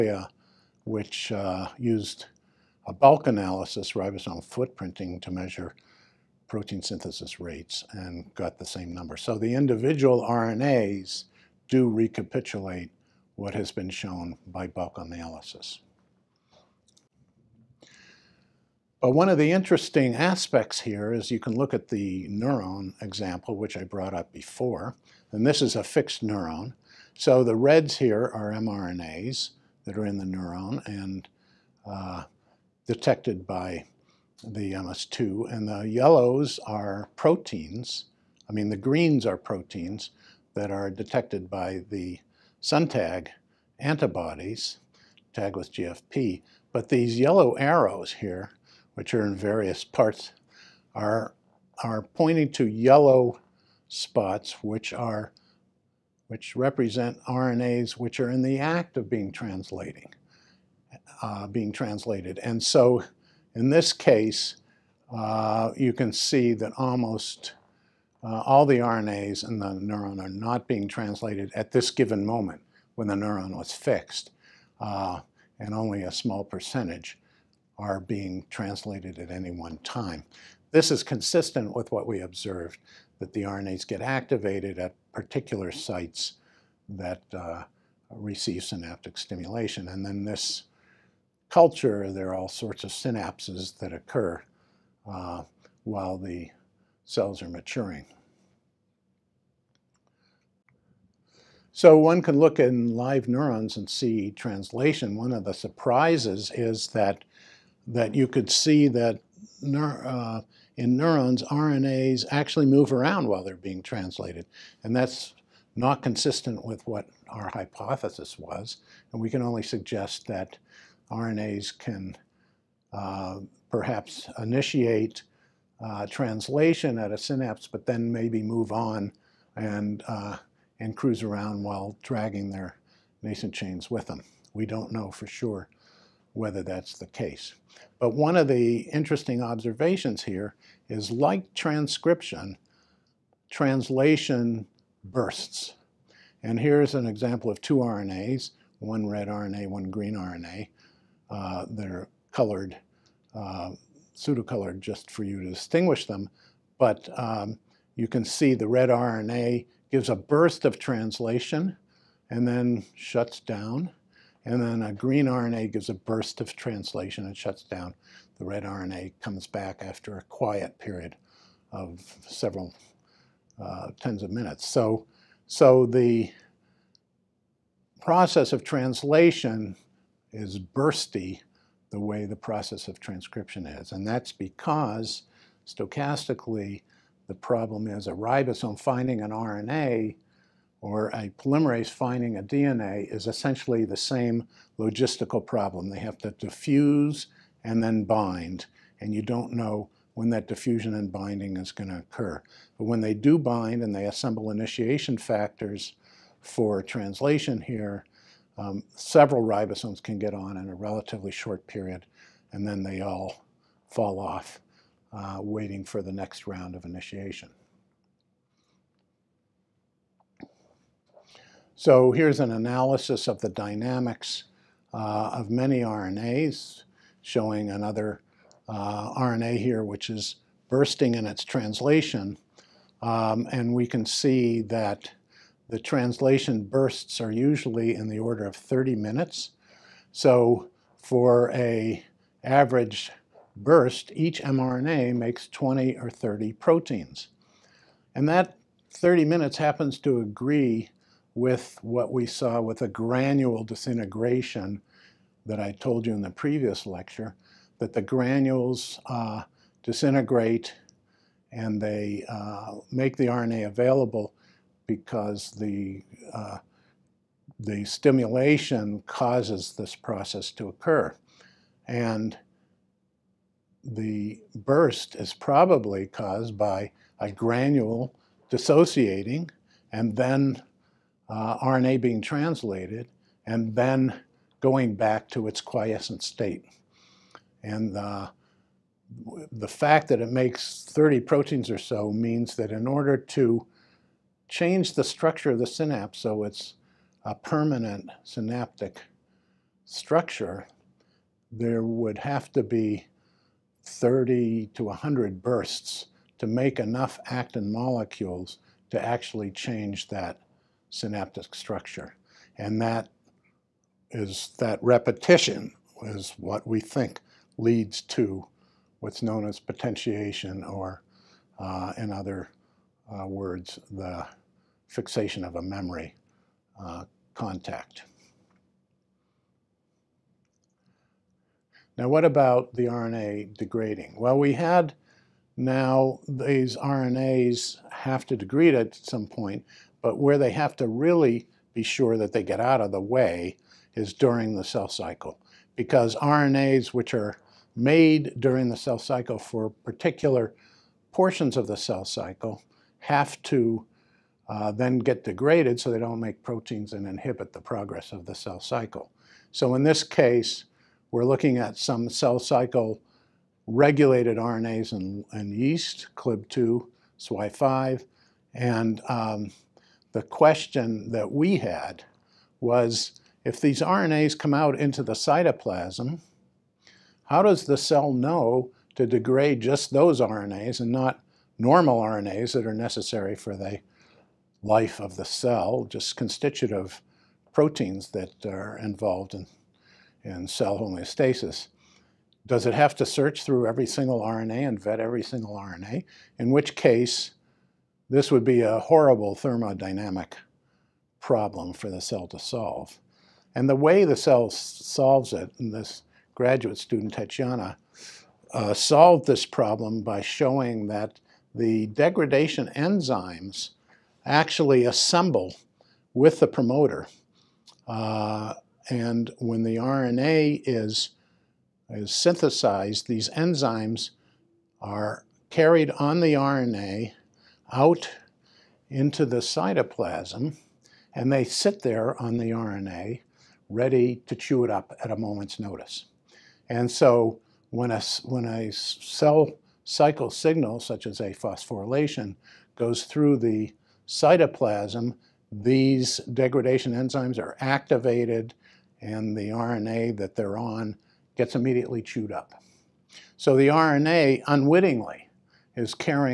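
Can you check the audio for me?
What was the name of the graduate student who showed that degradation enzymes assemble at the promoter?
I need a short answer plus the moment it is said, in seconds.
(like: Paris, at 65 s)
Tatiana, at 407 s.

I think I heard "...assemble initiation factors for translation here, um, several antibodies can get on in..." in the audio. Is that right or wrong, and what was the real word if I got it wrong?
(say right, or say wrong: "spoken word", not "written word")
wrong: "ribosomes", not "antibodies".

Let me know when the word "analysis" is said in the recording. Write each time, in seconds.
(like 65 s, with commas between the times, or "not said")
3 s, 14 s, 222 s.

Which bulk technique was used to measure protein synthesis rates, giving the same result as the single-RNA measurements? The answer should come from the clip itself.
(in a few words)
ribosome footprinting.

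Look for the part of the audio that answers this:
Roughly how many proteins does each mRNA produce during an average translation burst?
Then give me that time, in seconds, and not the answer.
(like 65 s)
245 s.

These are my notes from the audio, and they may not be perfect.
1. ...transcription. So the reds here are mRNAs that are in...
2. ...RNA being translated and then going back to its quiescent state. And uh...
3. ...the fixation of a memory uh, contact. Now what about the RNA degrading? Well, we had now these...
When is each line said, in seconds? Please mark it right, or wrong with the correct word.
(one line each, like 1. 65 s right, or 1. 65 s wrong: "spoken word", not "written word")
1. 26 s wrong: "neuron", not "transcription"
2. 281 s right
3. 323 s right.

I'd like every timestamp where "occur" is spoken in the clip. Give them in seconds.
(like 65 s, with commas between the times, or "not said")
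93 s, 201 s, 270 s.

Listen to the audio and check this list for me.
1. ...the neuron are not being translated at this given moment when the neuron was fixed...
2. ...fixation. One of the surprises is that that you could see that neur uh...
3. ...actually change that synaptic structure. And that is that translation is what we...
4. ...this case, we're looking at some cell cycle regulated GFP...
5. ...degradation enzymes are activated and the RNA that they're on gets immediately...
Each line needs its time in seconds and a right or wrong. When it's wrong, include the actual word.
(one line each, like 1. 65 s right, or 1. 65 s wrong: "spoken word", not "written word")
1. 69 s right
2. 104 s wrong: "translation", not "fixation"
3. 309 s wrong: "repetition", not "translation"
4. 359 s wrong: "RNAs", not "GFP"
5. 446 s right.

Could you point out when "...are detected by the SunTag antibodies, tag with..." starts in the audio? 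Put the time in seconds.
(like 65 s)
40 s.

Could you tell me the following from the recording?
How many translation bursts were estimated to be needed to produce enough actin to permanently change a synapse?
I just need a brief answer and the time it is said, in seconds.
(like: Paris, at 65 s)
30 to 100, at 303 s.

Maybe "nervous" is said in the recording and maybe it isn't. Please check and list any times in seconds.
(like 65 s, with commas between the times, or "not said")
not said.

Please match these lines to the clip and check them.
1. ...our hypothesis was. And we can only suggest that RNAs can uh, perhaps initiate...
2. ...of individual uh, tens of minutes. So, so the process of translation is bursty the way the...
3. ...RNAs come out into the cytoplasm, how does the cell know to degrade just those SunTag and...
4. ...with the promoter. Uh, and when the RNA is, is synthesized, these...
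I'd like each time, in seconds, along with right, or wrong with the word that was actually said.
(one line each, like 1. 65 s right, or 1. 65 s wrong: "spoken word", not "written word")
1. 117 s right
2. 171 s wrong: "several", not "individual"
3. 373 s wrong: "RNAs", not "SunTag"
4. 416 s right.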